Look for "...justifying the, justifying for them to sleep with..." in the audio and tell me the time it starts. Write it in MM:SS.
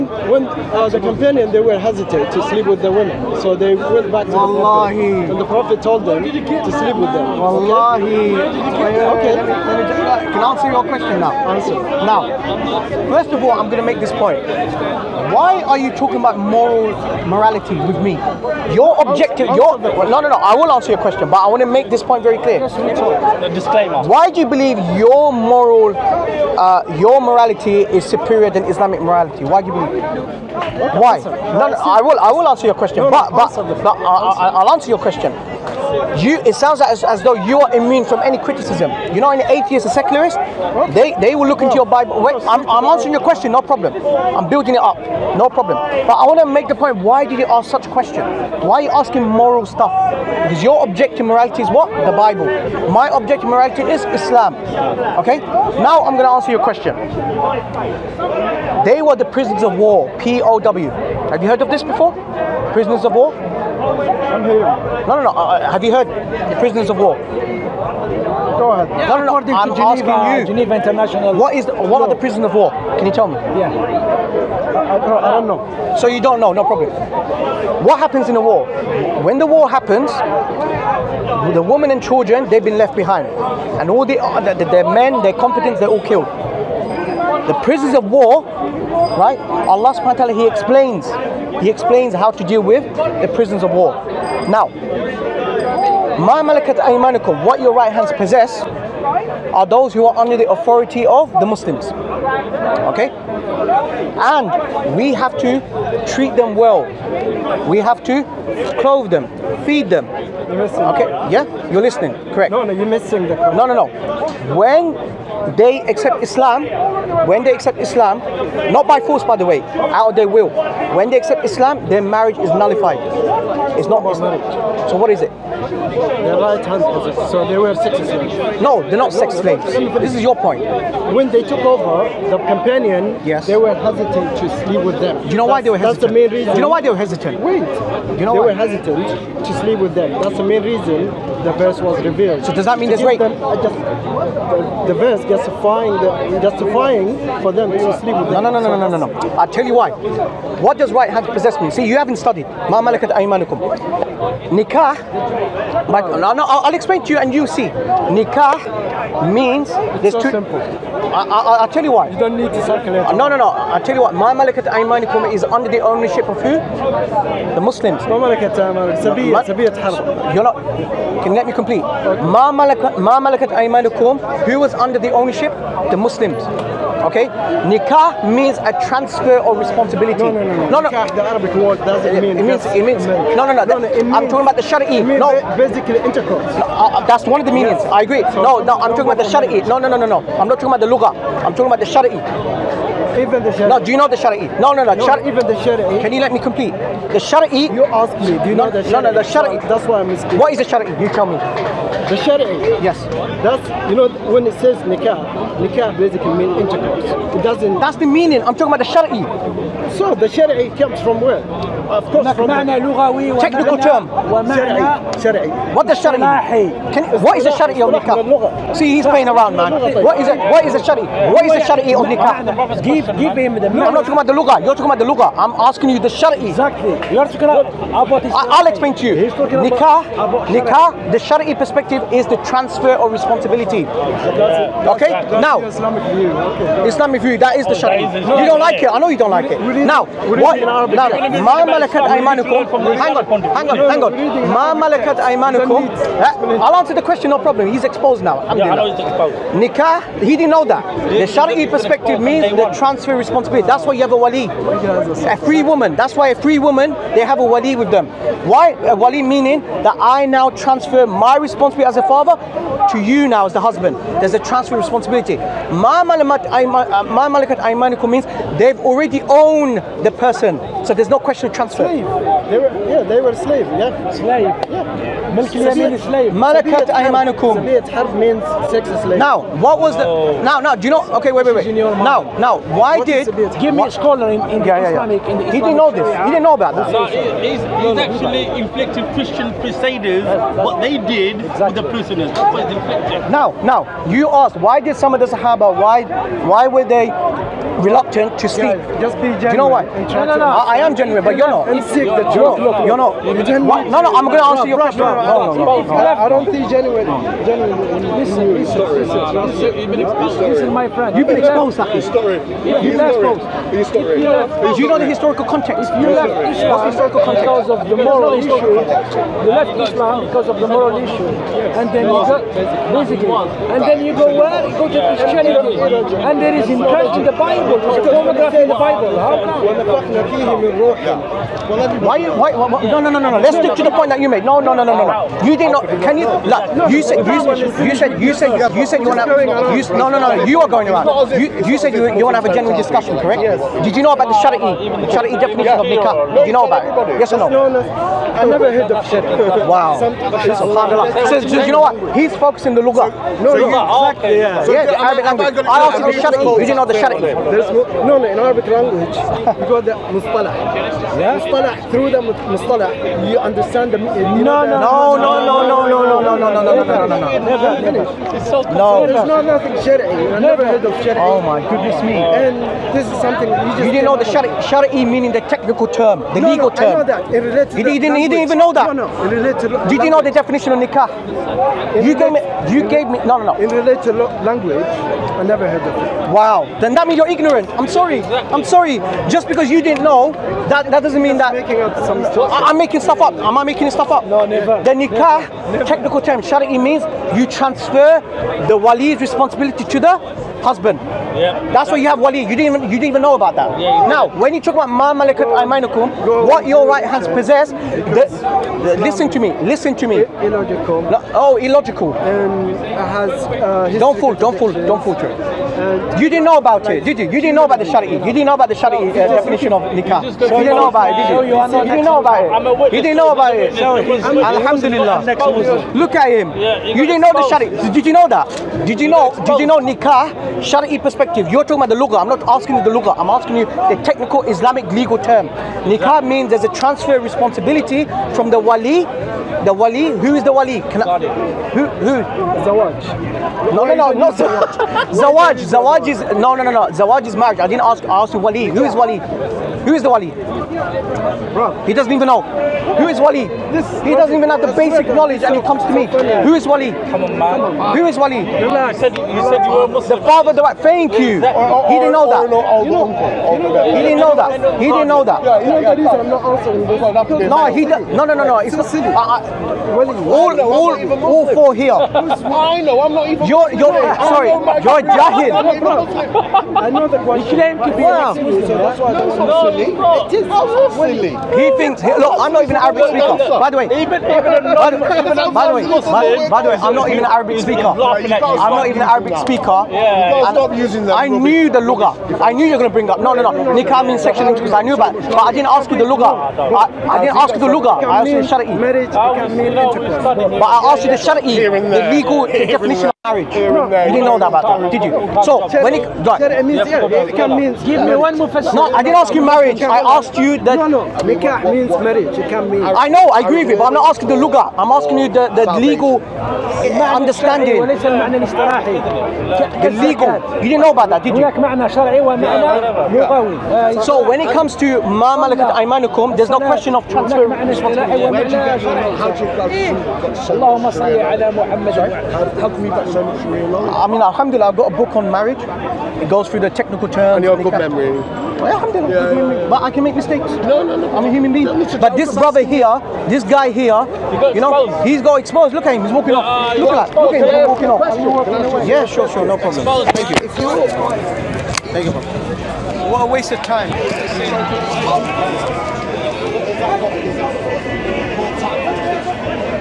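02:25.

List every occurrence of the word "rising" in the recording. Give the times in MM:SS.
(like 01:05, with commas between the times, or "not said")
not said.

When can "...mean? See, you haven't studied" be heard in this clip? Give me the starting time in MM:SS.
02:31.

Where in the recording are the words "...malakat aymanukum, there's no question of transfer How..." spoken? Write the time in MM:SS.
08:45.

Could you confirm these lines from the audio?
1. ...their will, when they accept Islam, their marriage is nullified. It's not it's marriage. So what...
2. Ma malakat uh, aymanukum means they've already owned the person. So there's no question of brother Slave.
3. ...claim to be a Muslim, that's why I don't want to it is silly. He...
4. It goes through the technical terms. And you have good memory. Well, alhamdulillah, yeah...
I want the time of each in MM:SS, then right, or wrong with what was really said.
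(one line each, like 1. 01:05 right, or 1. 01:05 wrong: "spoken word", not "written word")
1. 02:00 right
2. 04:25 wrong: "transfer", not "brother"
3. 07:57 right
4. 08:56 right.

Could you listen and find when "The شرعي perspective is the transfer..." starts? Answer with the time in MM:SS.
03:51.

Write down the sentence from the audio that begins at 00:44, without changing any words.
I'm building it up, no problem.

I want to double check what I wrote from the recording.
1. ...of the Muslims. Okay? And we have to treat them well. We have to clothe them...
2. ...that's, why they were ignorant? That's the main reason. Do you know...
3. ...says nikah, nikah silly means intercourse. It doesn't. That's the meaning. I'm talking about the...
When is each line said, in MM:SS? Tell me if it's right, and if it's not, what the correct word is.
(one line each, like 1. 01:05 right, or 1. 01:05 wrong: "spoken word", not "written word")
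1. 01:41 right
2. 02:15 wrong: "hesitant", not "ignorant"
3. 03:24 wrong: "basically", not "silly".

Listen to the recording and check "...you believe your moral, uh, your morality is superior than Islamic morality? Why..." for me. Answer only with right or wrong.
right.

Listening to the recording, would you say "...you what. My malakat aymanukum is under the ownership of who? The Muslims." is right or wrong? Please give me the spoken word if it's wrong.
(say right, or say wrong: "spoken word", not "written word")
right.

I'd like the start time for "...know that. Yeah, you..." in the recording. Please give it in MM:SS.
07:45.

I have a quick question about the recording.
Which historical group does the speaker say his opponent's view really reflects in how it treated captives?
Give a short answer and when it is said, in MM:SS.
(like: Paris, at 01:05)
Christian crusaders, at 04:49.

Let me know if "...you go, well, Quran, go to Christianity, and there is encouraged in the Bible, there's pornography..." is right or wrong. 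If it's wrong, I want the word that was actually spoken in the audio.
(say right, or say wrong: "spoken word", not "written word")
right.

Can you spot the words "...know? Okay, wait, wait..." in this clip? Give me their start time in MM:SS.
04:40.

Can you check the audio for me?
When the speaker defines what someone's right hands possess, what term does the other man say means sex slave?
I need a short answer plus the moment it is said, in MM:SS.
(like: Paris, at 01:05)
Malakat harb, at 04:36.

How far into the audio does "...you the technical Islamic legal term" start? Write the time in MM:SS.
07:13.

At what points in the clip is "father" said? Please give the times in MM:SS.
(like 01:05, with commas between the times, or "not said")
04:22, 07:40.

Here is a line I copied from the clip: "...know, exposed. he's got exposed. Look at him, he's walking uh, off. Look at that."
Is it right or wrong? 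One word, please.
right.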